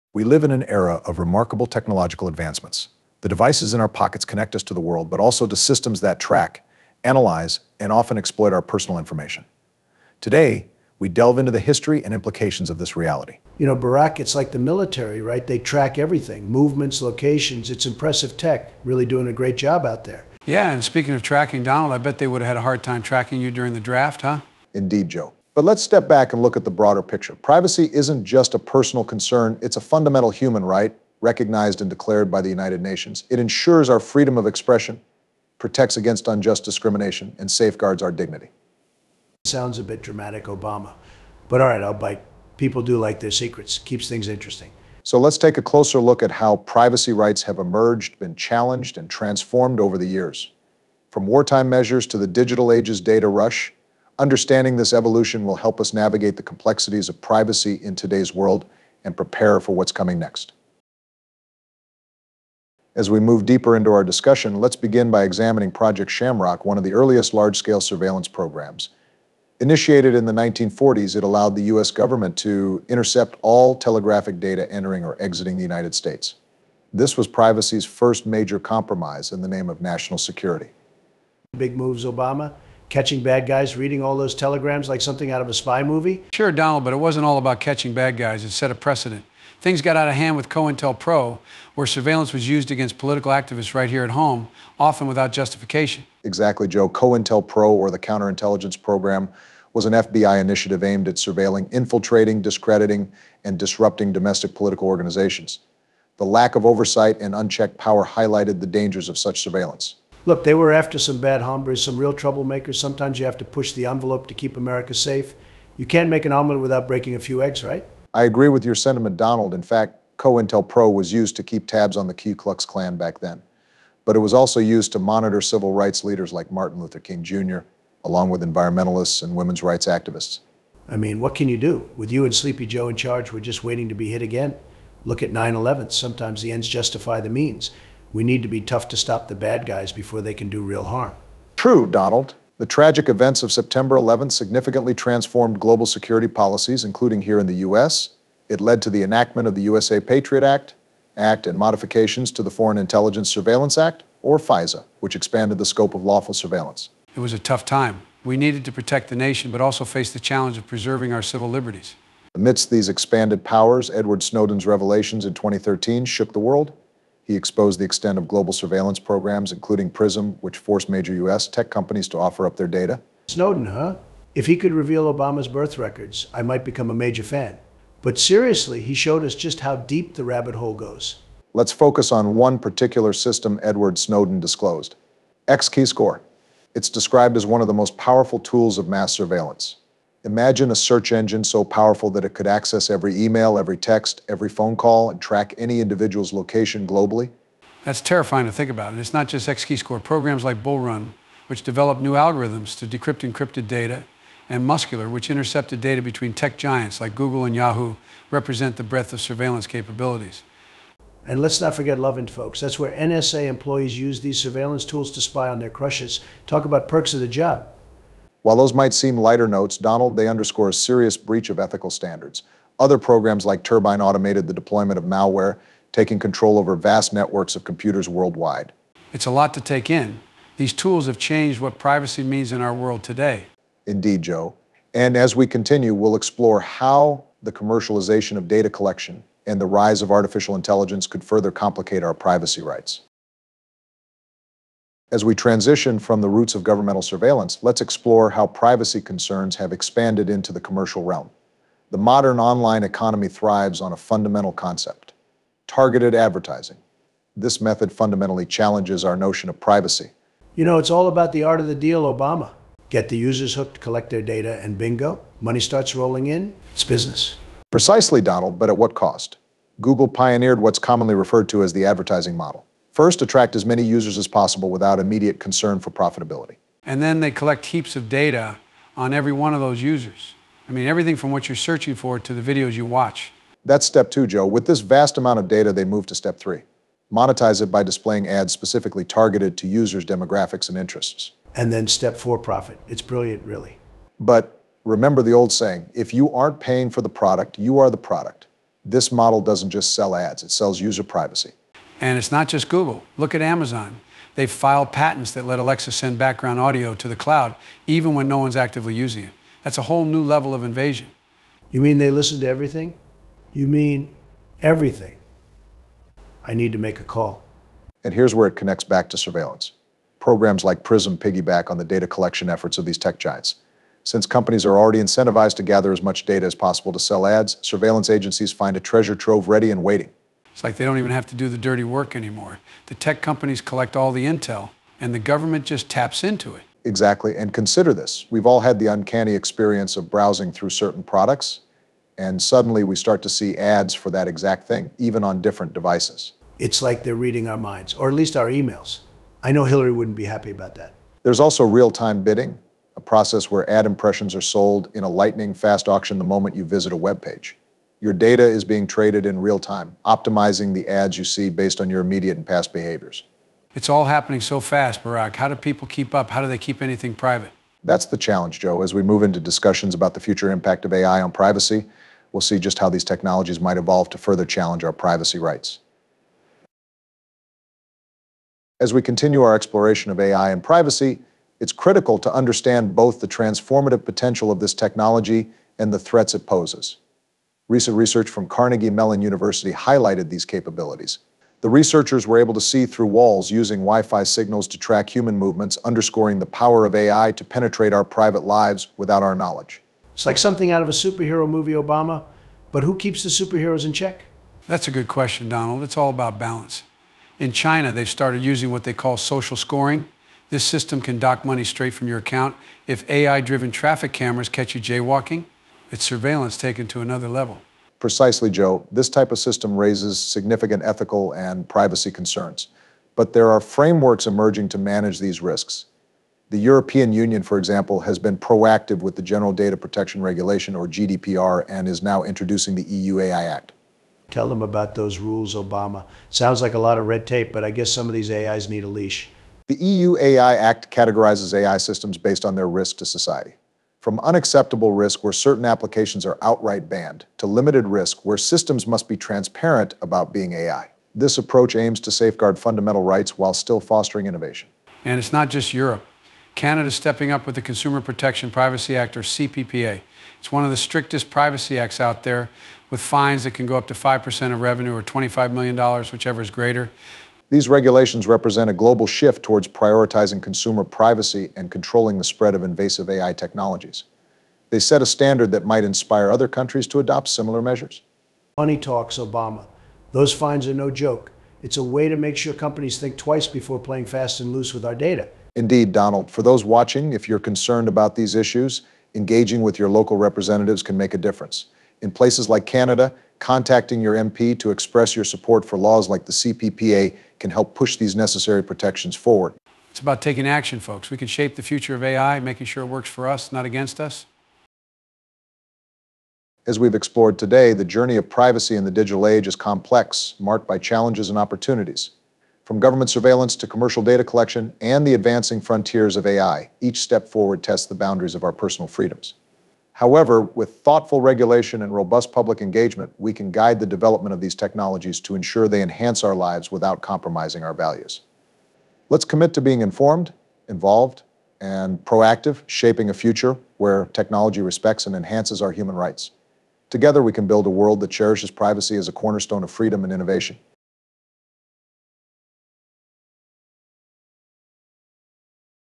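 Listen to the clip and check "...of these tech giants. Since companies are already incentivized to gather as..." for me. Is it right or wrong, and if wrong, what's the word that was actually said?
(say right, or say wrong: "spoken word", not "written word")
right.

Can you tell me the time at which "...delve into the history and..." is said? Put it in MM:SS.
00:11.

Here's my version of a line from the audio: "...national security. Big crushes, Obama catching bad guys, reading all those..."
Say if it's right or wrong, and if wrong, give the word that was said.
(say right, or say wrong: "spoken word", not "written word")
wrong: "moves", not "crushes".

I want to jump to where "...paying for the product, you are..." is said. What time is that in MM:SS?
04:56.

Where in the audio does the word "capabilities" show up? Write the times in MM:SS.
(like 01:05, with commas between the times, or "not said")
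03:29, 06:30.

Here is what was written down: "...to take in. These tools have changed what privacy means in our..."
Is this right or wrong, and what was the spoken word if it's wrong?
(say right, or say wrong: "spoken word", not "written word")
right.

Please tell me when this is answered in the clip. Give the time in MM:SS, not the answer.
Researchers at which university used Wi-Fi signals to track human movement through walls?
06:28.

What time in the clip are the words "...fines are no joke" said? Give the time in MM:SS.
08:00.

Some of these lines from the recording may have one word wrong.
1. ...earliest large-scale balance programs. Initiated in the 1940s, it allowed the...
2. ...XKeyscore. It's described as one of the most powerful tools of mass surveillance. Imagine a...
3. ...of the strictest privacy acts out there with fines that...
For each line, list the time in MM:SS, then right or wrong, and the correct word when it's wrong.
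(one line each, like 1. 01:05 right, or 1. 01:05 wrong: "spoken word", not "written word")
1. 01:06 wrong: "surveillance", not "balance"
2. 03:05 right
3. 07:40 right.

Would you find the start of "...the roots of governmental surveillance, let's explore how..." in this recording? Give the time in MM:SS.
04:06.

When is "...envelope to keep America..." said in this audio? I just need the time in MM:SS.
01:53.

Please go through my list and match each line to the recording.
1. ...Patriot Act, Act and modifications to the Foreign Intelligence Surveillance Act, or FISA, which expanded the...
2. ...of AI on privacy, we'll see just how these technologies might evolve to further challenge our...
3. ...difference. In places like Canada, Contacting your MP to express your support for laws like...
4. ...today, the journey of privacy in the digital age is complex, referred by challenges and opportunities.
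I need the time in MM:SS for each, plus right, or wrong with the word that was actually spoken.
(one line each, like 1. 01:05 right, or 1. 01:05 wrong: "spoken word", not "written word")
1. 02:29 right
2. 06:10 right
3. 08:11 right
4. 08:27 wrong: "marked", not "referred".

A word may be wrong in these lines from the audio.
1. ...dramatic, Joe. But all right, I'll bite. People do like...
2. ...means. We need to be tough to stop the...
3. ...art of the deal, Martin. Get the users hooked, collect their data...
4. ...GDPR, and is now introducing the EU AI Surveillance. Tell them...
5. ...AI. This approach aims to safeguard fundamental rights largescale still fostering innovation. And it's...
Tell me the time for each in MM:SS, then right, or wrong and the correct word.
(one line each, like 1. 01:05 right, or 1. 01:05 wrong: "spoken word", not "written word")
1. 00:40 wrong: "Obama", not "Joe"
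2. 02:17 right
3. 04:21 wrong: "Obama", not "Martin"
4. 07:10 wrong: "Act", not "Surveillance"
5. 07:30 wrong: "while", not "largescale".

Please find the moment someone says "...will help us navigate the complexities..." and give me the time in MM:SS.
00:55.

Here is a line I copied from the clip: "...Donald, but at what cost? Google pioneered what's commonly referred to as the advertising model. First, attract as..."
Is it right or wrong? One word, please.
right.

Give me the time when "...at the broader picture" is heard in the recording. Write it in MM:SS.
00:26.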